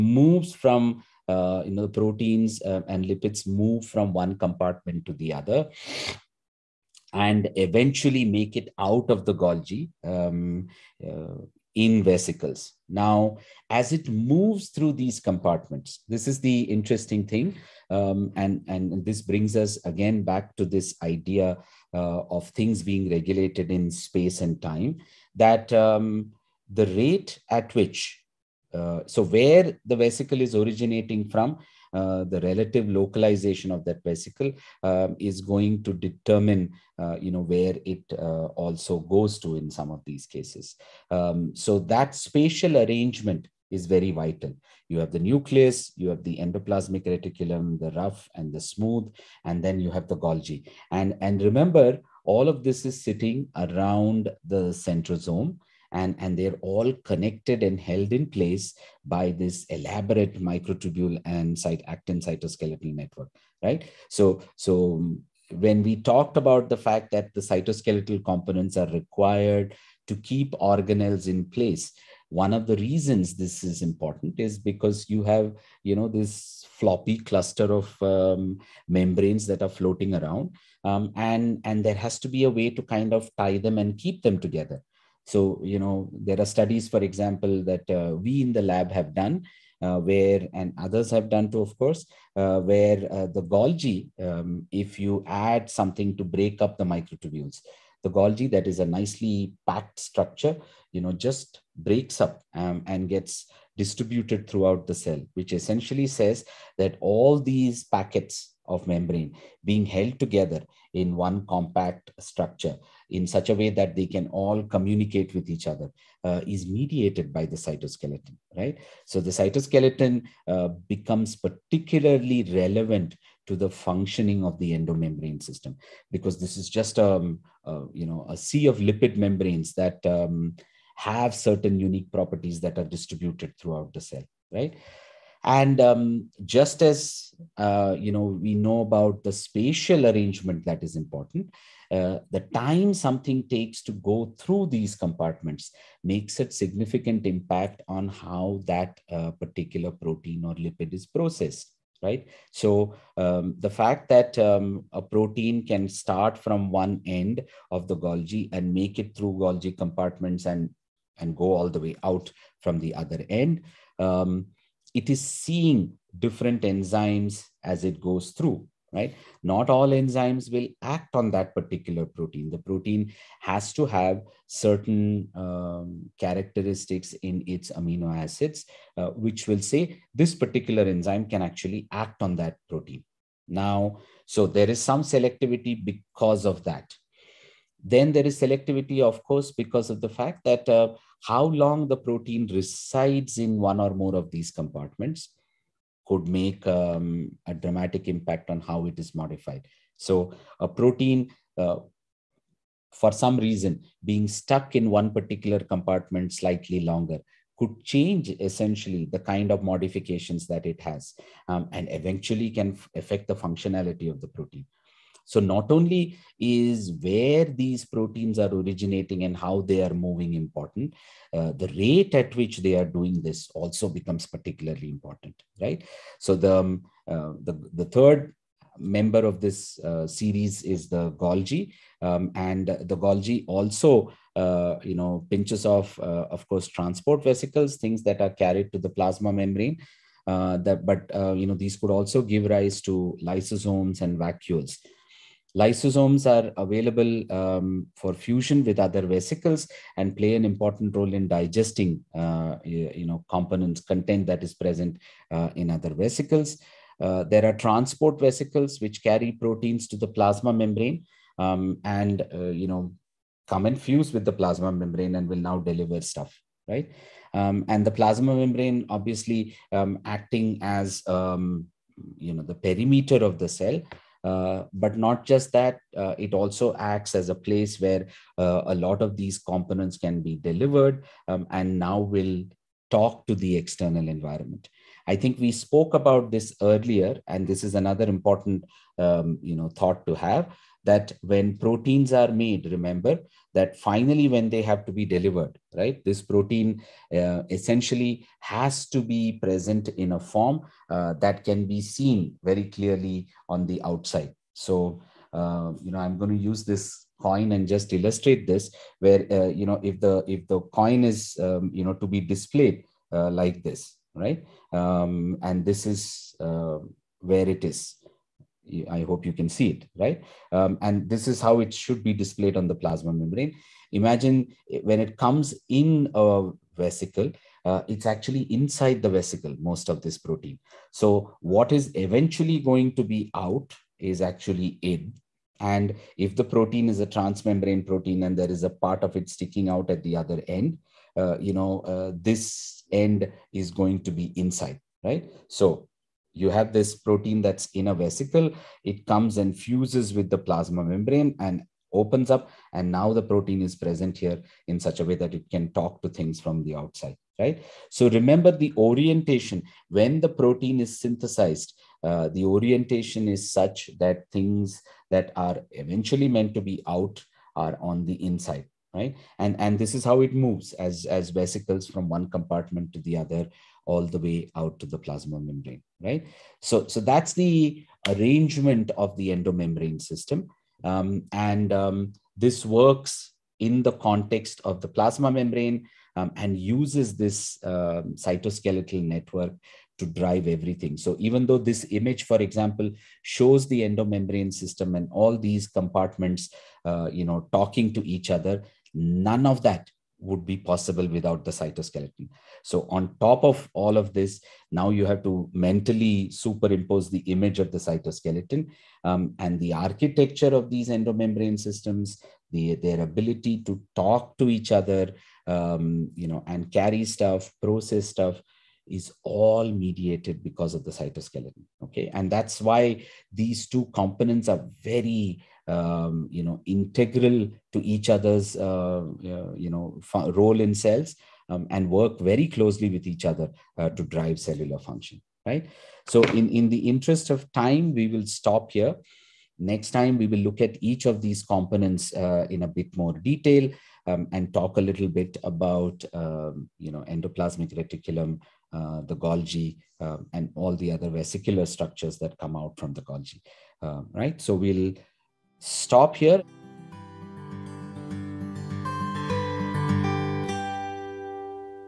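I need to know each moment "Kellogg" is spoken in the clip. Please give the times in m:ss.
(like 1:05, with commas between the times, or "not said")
not said.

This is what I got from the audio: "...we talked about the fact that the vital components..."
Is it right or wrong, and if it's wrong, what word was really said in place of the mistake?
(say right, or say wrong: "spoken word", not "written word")
wrong: "cytoskeletal", not "vital".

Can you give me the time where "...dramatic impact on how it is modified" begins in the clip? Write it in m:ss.
3:17.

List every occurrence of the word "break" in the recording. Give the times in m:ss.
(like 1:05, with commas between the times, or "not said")
1:36, 1:41.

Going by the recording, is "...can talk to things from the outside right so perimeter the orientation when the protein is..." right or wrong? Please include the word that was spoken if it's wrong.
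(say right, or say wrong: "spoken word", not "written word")
wrong: "remember", not "perimeter".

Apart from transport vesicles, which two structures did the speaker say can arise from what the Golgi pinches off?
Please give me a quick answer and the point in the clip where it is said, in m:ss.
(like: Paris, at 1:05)
Lysosomes and vacuoles, at 4:03.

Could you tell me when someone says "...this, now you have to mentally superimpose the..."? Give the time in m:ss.
6:44.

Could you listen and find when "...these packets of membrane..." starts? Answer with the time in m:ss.
1:47.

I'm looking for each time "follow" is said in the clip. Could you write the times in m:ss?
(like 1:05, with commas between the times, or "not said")
not said.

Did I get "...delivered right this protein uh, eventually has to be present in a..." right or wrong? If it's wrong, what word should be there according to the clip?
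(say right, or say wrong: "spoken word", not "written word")
wrong: "essentially", not "eventually".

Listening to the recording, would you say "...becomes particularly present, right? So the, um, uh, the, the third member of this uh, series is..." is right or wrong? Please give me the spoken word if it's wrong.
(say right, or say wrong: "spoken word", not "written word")
wrong: "important", not "present".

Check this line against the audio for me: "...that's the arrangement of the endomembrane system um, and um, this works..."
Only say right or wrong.
right.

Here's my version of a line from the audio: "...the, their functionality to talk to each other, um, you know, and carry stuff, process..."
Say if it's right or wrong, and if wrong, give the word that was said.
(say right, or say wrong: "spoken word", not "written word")
wrong: "ability", not "functionality".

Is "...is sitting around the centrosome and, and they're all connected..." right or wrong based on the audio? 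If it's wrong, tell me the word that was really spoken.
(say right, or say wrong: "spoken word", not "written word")
right.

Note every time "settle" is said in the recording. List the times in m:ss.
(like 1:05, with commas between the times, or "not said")
not said.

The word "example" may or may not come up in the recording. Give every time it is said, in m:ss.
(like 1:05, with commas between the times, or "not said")
1:27, 6:32.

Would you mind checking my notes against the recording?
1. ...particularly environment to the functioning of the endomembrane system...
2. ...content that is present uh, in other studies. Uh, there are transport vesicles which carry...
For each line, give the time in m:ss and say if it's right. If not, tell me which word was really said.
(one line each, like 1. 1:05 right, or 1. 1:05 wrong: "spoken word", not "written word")
1. 2:01 wrong: "relevant", not "environment"
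2. 4:13 wrong: "vesicles", not "studies".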